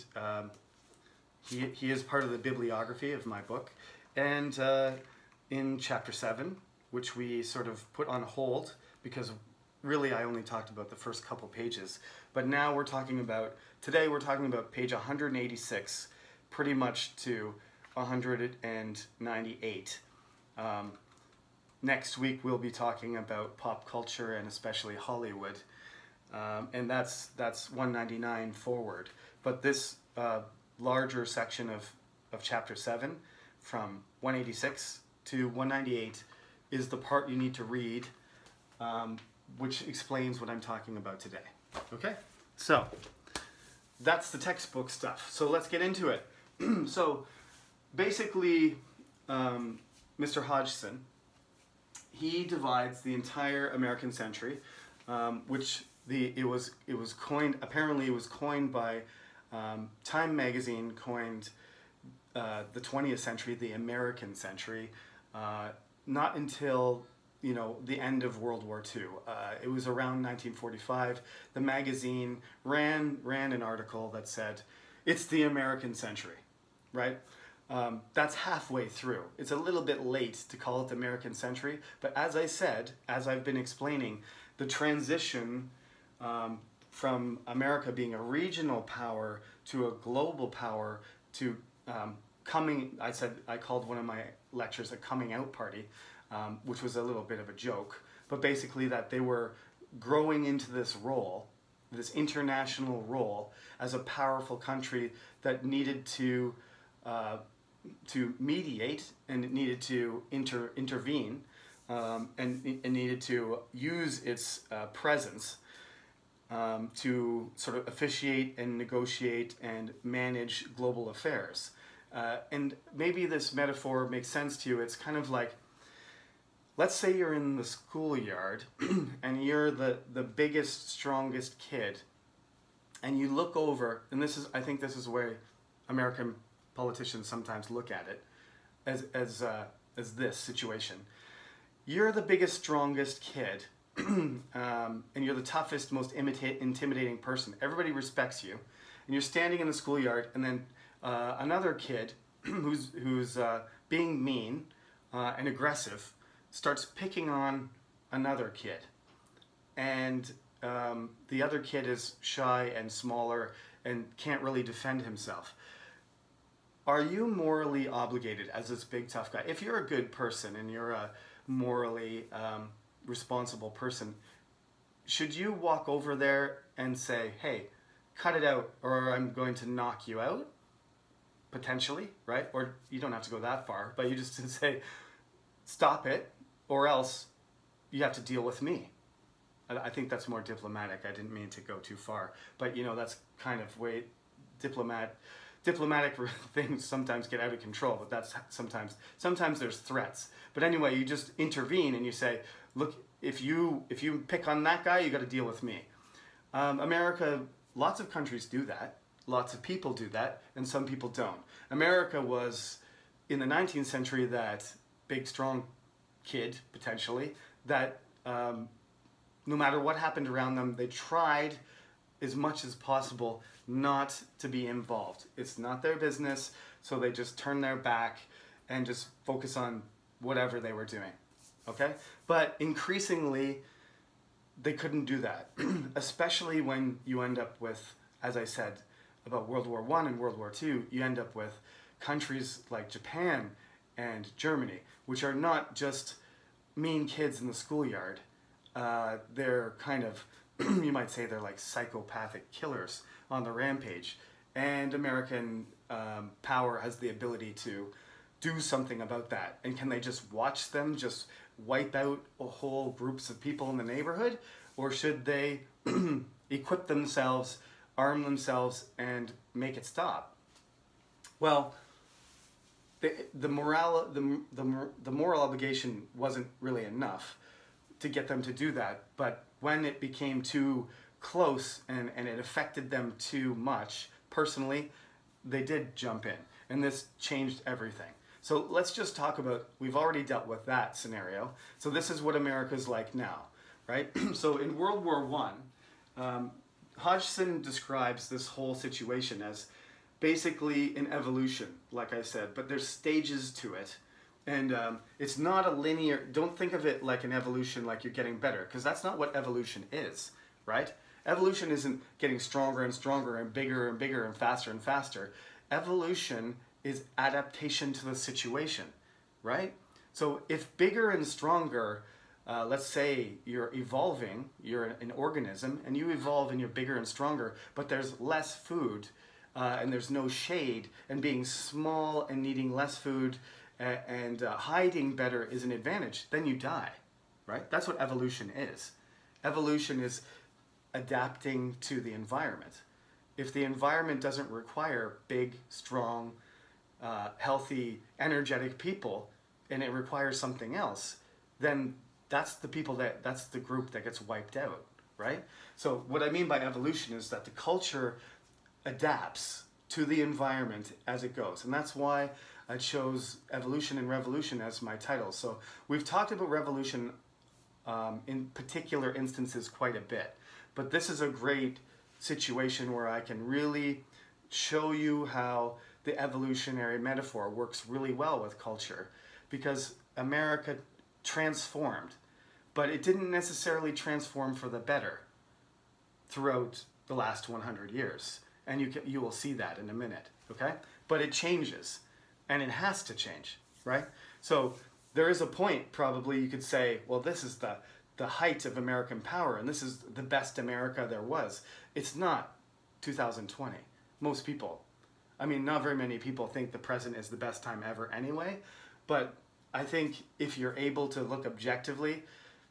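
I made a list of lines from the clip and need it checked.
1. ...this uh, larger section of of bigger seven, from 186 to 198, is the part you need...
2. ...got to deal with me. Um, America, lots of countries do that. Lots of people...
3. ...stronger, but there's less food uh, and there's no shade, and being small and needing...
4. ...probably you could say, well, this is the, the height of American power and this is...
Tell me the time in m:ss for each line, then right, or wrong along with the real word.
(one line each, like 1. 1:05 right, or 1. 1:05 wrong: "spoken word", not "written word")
1. 0:29 wrong: "chapter", not "bigger"
2. 3:25 right
3. 5:27 right
4. 6:35 right.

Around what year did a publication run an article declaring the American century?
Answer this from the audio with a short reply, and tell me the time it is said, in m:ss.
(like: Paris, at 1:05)
1945, at 1:10.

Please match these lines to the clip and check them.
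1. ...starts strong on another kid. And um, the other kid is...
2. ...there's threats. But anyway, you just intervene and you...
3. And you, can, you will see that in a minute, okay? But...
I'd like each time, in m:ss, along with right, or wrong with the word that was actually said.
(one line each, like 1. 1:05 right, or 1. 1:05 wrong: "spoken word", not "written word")
1. 2:36 wrong: "picking", not "strong"
2. 3:19 right
3. 6:28 right.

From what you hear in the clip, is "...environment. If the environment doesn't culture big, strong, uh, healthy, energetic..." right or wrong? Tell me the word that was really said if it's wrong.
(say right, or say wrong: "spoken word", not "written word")
wrong: "require", not "culture".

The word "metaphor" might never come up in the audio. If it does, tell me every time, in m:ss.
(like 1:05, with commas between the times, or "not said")
2:03, 6:16.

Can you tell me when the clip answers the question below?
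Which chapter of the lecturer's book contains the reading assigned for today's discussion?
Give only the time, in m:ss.
0:05.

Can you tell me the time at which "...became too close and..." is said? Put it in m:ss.
4:39.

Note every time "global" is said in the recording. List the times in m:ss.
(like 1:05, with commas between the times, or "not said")
1:29, 2:00.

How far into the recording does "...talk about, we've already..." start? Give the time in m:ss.
4:49.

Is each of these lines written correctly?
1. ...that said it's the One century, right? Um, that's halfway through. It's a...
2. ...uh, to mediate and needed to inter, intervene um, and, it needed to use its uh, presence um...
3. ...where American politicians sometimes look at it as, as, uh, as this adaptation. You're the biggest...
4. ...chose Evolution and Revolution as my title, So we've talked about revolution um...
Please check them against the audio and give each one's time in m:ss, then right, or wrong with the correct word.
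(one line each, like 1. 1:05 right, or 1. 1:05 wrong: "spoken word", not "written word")
1. 1:14 wrong: "American", not "One"
2. 1:47 right
3. 2:15 wrong: "situation", not "adaptation"
4. 6:02 right.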